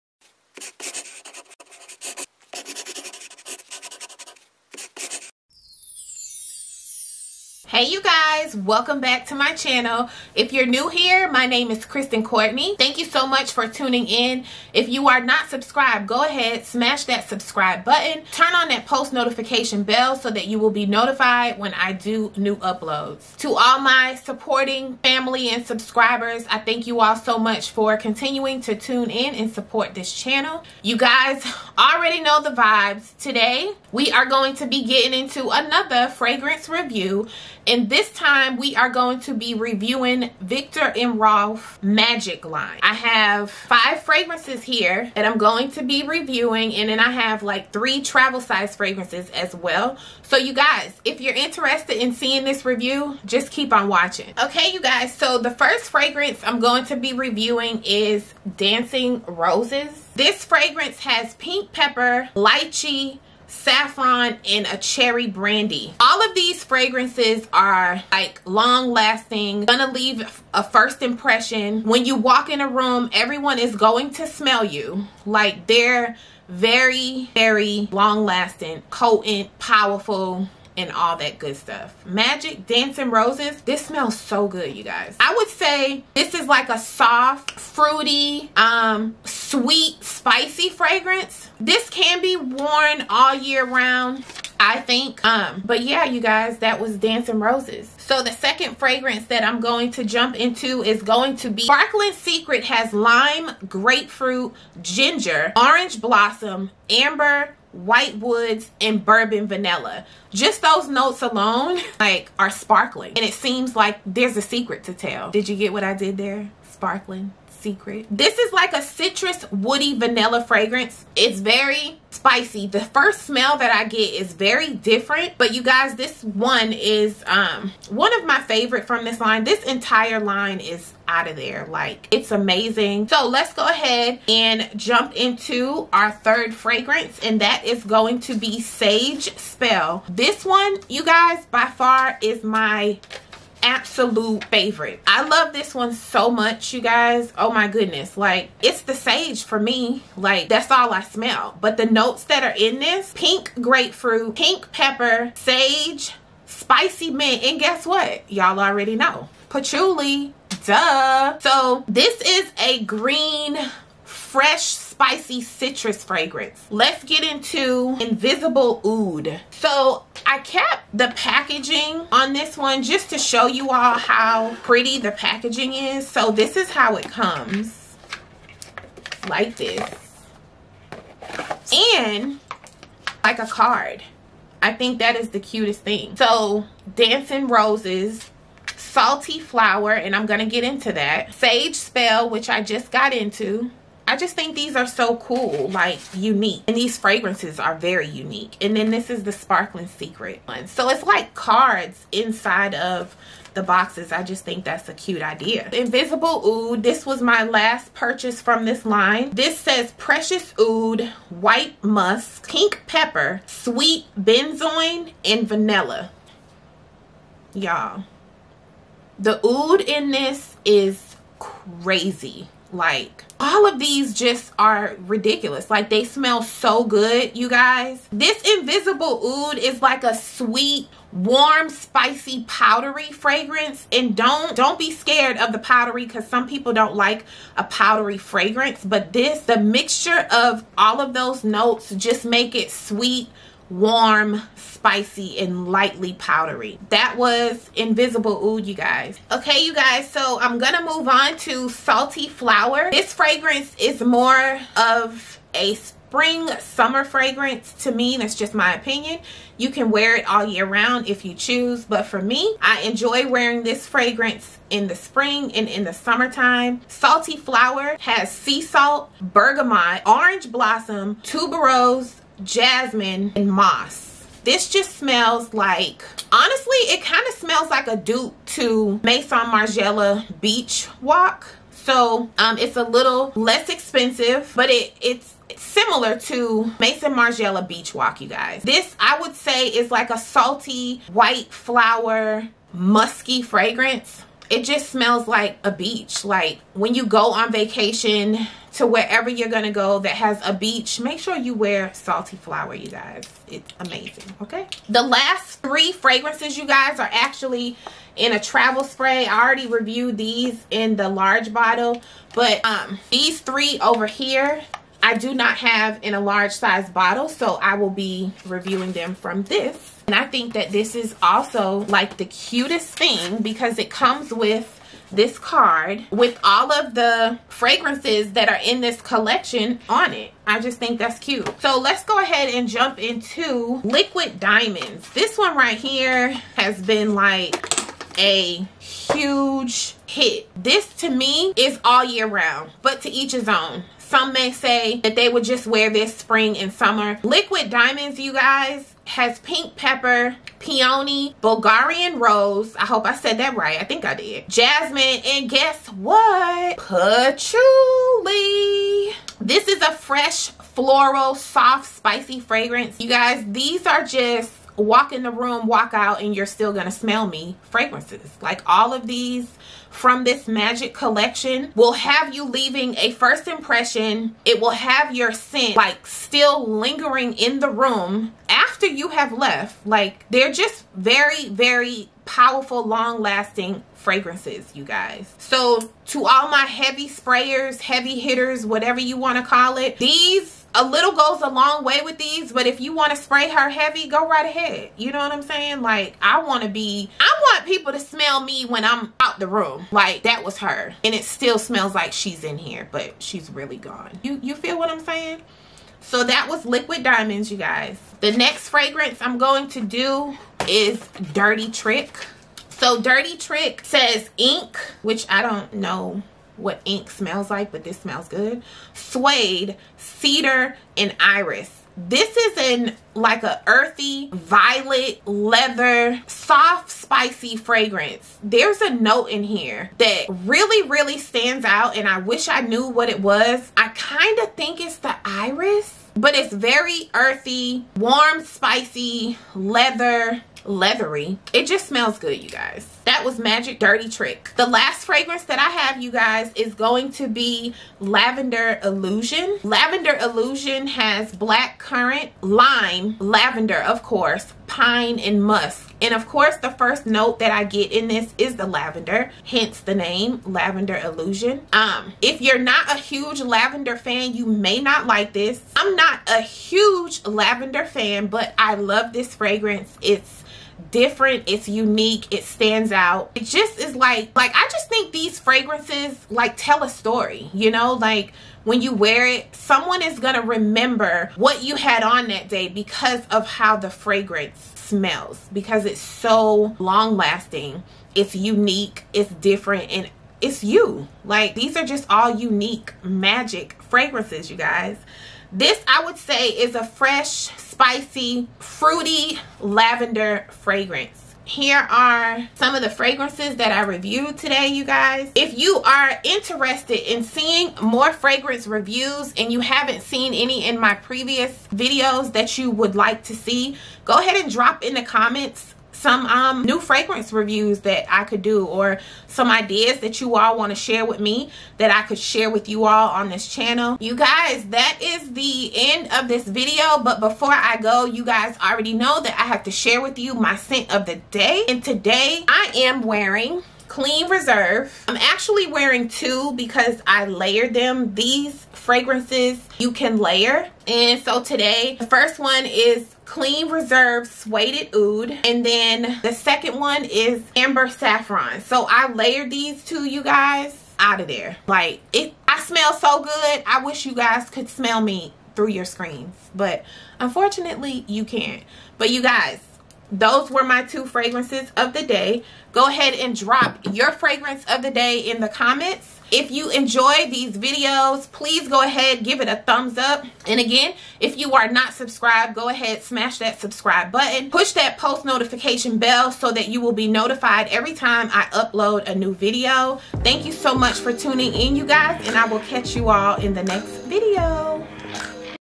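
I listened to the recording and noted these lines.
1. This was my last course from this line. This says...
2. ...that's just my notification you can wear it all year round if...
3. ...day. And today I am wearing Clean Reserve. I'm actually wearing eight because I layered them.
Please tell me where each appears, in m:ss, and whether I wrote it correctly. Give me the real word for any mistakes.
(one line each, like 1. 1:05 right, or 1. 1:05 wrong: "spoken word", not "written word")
1. 3:26 wrong: "purchase", not "course"
2. 4:18 wrong: "opinion", not "notification"
3. 8:51 wrong: "two", not "eight".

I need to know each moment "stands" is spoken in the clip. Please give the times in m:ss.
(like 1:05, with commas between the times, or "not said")
7:11, 7:52.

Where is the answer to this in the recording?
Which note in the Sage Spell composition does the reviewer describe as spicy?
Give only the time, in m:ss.
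2:36.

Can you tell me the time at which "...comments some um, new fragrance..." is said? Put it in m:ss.
8:35.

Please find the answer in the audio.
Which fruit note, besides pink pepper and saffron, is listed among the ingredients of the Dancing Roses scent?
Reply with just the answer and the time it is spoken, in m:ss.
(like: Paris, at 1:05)
Lychee, at 1:02.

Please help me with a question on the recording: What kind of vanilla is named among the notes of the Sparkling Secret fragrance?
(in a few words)
Bourbon vanilla.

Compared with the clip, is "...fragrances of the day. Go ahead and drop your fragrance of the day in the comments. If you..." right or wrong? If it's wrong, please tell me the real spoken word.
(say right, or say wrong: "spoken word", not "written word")
right.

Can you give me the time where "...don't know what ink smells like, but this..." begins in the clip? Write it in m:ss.
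6:55.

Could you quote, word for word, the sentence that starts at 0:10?
If you're new here, my name is Kristin Courtney.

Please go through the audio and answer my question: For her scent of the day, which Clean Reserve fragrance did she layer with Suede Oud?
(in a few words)
Amber Saffron.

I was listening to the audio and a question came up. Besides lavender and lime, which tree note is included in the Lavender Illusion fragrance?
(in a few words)
Pine.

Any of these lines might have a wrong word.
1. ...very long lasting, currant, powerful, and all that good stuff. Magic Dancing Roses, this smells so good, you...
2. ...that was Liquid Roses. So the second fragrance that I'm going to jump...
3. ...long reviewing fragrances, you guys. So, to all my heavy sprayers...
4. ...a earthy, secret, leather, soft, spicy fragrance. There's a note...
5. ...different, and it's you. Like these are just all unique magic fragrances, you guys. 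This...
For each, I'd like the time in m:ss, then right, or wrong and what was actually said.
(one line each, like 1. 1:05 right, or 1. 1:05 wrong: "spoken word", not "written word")
1. 1:17 wrong: "potent", not "currant"
2. 1:36 wrong: "Dancing", not "Liquid"
3. 6:22 wrong: "lasting", not "reviewing"
4. 7:03 wrong: "violet", not "secret"
5. 8:09 right.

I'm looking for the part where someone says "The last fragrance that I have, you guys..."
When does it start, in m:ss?
7:24.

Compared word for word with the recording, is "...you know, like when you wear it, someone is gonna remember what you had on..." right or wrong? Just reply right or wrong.
right.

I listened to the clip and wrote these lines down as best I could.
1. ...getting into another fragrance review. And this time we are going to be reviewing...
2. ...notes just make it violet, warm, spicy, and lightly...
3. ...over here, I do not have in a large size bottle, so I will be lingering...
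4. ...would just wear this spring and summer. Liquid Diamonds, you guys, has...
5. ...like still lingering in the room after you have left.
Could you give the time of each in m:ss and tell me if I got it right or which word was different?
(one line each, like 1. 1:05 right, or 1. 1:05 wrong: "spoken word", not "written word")
1. 0:34 right
2. 4:01 wrong: "sweet", not "violet"
3. 5:13 wrong: "reviewing", not "lingering"
4. 5:45 right
5. 6:15 right.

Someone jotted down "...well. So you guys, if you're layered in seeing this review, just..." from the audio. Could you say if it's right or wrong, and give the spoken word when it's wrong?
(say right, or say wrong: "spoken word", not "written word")
wrong: "interested", not "layered".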